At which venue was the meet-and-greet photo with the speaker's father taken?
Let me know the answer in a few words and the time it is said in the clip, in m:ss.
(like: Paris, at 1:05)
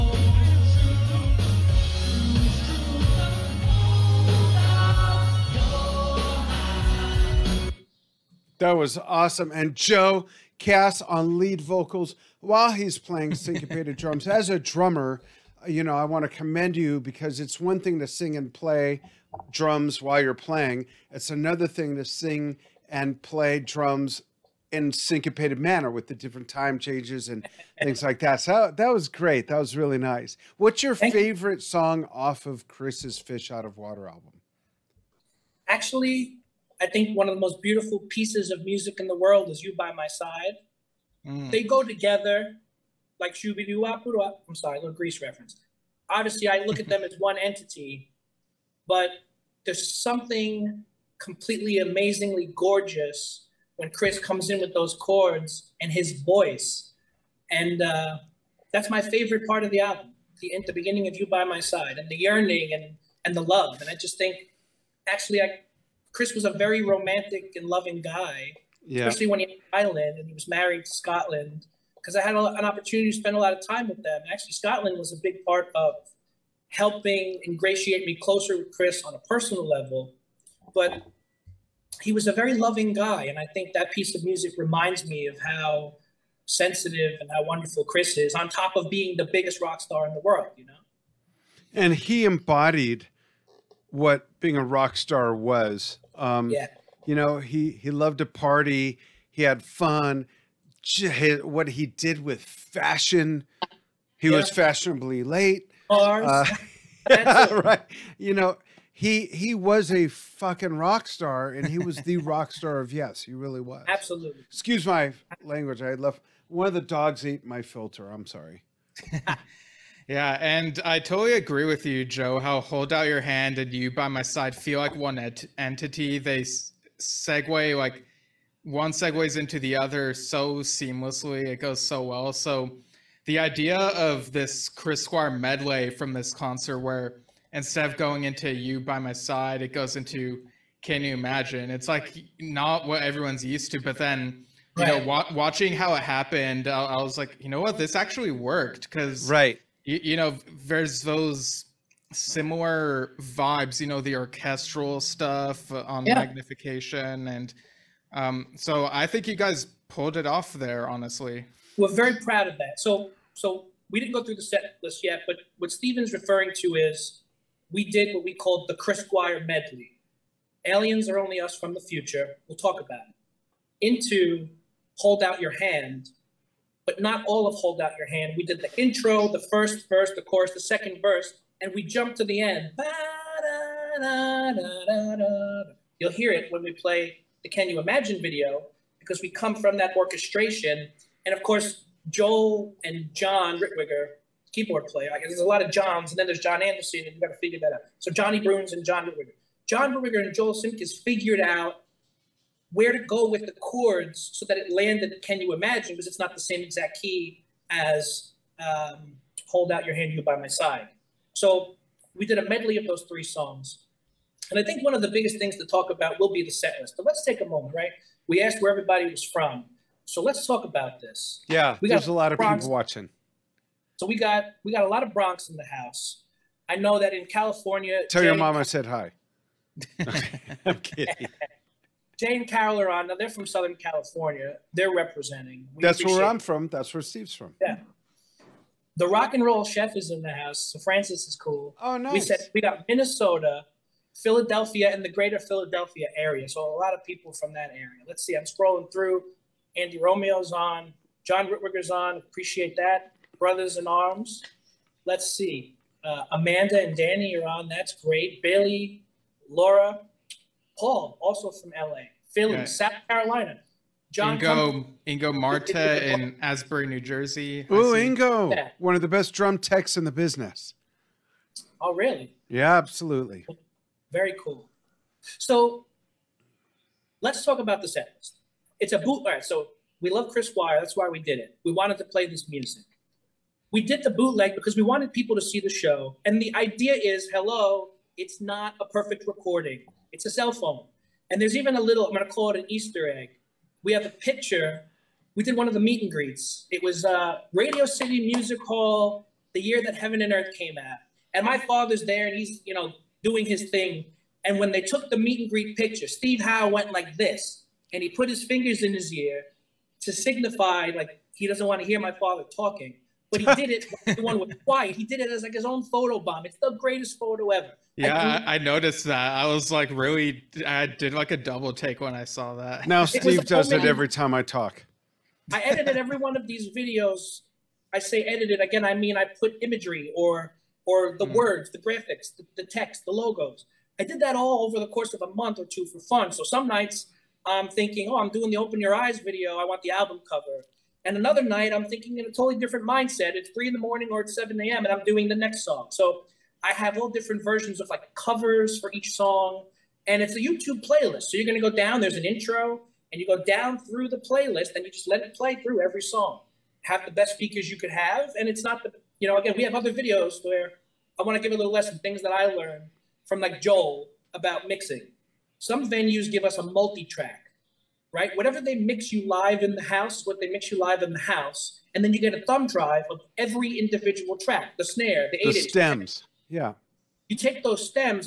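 Radio City Music Hall, at 4:57.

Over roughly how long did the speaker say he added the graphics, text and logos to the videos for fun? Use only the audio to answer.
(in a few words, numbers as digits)
a month or two.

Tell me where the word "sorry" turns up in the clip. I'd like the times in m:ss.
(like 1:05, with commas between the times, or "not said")
0:44, 1:58.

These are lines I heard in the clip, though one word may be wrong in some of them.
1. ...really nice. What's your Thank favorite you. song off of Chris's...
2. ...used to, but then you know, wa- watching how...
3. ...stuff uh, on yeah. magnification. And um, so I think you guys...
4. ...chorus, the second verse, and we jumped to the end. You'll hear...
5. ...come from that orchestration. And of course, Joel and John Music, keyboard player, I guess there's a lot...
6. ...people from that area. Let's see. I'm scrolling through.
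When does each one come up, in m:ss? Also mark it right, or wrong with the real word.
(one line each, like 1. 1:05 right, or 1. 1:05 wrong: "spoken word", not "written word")
1. 0:29 right
2. 2:23 right
3. 2:35 right
4. 3:00 right
5. 3:09 wrong: "Ritwiger", not "Music"
6. 4:07 right.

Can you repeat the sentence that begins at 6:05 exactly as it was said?
Some venues give us a multi track right?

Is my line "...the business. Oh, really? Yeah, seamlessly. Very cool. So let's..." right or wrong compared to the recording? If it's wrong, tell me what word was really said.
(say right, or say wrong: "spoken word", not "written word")
wrong: "absolutely", not "seamlessly".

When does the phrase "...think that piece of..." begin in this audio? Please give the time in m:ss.
1:23.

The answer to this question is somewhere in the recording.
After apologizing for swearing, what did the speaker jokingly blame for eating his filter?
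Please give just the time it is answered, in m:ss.
1:56.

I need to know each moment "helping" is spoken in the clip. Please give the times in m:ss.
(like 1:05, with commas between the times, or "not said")
1:16.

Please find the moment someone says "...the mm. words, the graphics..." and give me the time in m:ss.
5:31.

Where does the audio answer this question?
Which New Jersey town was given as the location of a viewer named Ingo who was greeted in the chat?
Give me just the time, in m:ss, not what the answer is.
4:26.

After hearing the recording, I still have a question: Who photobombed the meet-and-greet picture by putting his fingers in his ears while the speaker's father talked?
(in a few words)
Steve Howe.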